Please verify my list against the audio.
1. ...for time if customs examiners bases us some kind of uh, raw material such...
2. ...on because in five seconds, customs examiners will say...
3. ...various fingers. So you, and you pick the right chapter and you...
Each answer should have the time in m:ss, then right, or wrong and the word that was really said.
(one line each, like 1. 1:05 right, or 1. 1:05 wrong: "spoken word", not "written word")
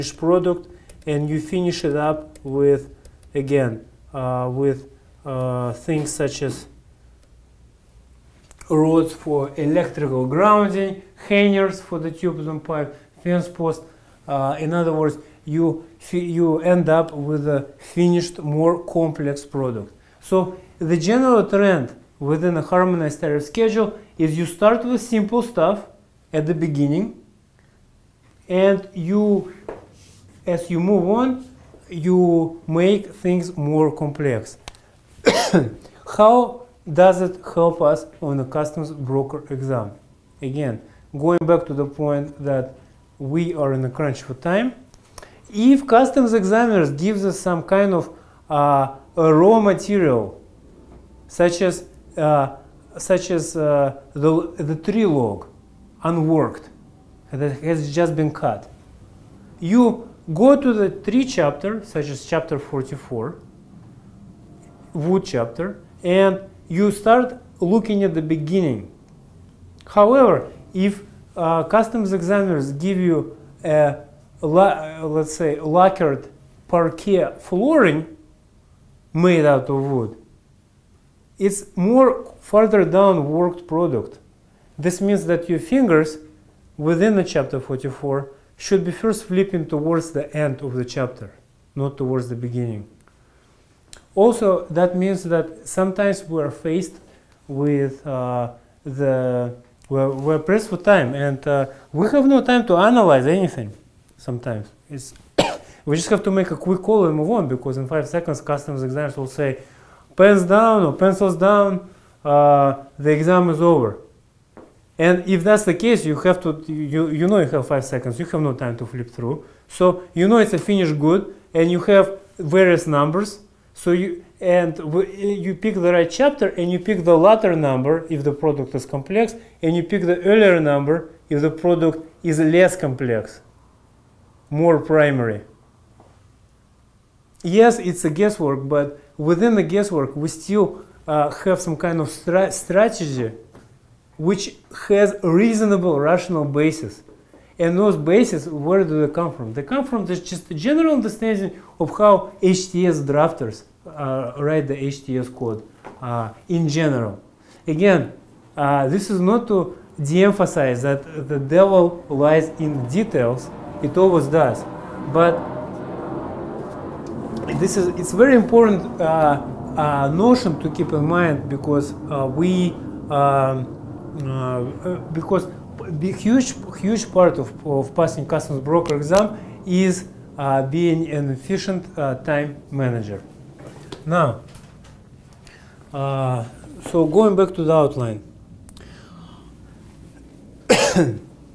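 1. 0:44 wrong: "gives", not "bases"
2. 1:47 right
3. 2:02 wrong: "numbers", not "fingers".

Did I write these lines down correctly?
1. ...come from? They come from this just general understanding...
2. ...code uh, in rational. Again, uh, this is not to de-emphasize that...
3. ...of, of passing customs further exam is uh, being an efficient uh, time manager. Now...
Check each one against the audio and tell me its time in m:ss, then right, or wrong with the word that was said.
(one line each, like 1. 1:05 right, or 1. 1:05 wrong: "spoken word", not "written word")
1. 2:29 right
2. 2:35 wrong: "general", not "rational"
3. 2:57 wrong: "broker", not "further".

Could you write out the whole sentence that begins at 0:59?
You go to the tree chapter, such as chapter 44, wood chapter, and you start looking at the beginning.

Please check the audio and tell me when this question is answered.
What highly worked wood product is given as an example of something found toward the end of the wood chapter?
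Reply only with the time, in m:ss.
1:15.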